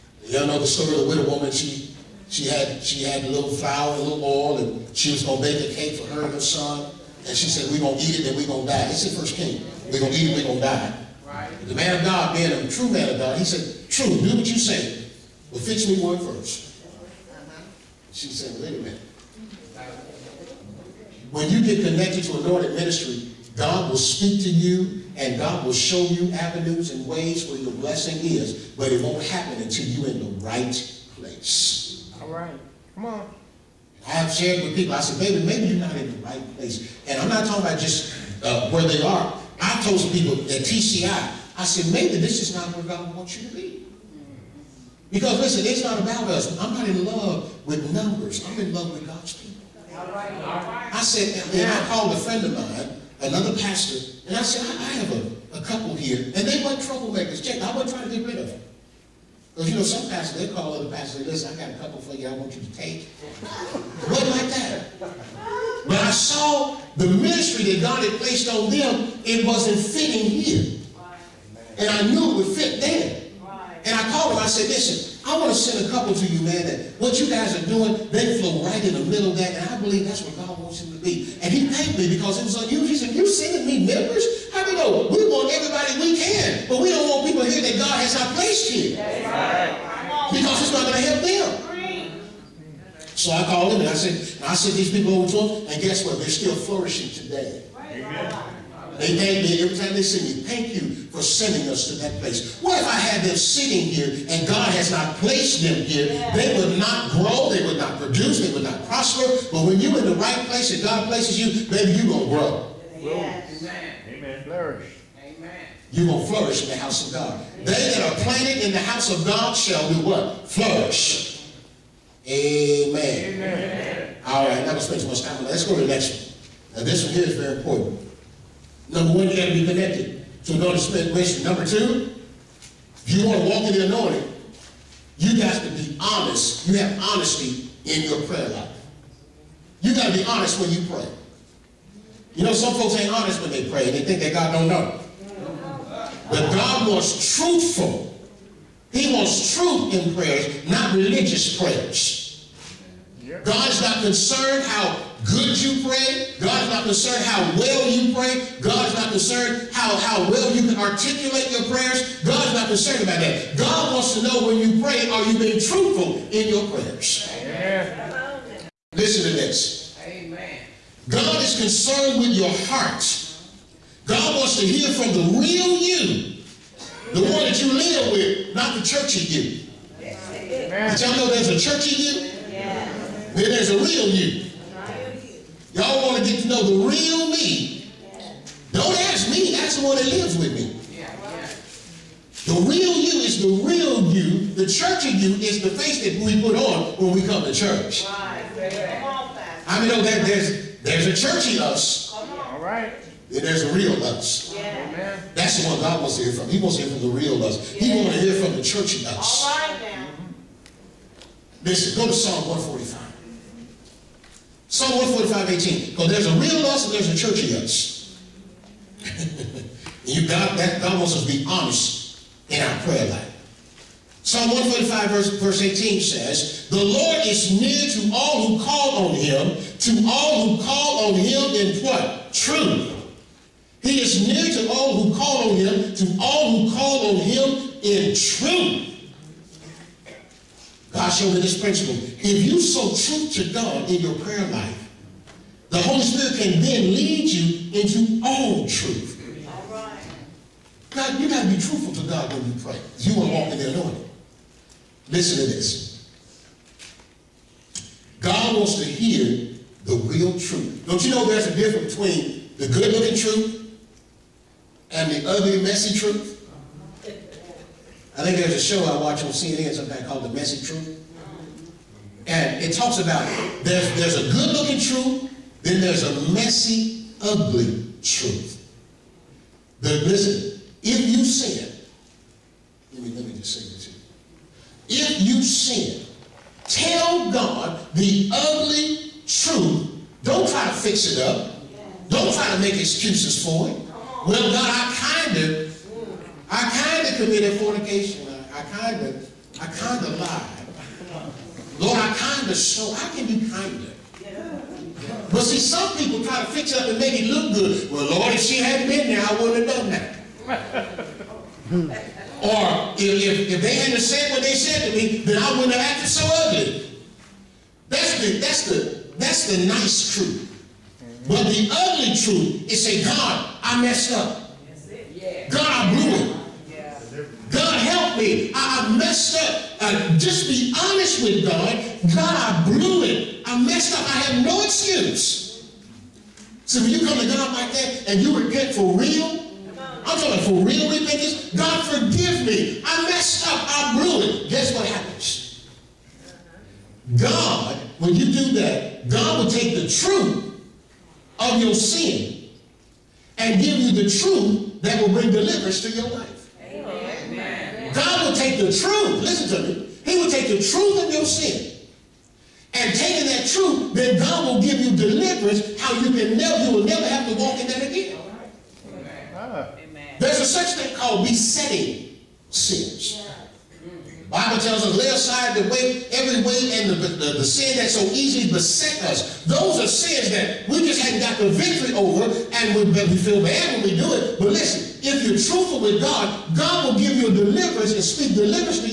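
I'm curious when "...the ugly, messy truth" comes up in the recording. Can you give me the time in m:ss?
4:25.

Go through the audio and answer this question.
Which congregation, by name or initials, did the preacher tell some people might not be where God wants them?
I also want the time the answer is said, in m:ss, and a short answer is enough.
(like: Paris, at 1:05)
TCI, at 0:40.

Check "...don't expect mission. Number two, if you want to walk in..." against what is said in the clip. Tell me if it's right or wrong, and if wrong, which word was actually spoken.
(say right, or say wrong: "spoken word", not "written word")
right.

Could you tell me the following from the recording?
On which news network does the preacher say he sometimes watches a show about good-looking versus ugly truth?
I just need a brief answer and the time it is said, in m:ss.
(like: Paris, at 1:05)
CNN, at 4:29.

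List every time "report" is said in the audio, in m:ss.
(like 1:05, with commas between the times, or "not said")
not said.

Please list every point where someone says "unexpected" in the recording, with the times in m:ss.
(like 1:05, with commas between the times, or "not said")
not said.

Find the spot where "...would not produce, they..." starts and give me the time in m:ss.
1:47.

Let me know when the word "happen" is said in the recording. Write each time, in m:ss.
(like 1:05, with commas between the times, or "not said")
0:29, 5:44.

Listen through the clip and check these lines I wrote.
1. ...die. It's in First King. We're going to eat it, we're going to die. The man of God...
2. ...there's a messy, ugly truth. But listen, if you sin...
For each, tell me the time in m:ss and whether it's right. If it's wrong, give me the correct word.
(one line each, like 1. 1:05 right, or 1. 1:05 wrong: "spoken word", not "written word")
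1. 0:08 right
2. 4:35 right.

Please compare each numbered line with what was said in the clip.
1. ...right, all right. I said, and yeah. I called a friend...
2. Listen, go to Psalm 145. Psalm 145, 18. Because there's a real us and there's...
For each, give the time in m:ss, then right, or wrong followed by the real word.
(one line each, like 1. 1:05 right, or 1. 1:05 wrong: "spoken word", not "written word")
1. 0:50 right
2. 3:31 right.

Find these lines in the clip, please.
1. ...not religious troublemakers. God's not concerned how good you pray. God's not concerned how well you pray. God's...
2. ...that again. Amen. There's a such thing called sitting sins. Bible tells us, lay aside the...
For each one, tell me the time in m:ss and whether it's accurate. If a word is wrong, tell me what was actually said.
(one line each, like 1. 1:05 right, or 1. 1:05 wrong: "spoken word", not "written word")
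1. 2:30 wrong: "prayers", not "troublemakers"
2. 6:07 wrong: "besetting", not "sitting".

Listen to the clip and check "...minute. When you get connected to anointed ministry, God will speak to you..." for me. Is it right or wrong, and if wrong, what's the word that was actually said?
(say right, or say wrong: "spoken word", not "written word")
right.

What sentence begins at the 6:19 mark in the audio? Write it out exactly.
Those are sins that we just hadn't got the victory over, and we, we feel bad when we do it.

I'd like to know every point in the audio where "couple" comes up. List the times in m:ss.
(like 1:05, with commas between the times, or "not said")
0:55, 1:01, 1:15.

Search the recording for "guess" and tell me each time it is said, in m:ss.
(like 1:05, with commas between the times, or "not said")
1:35, 5:44.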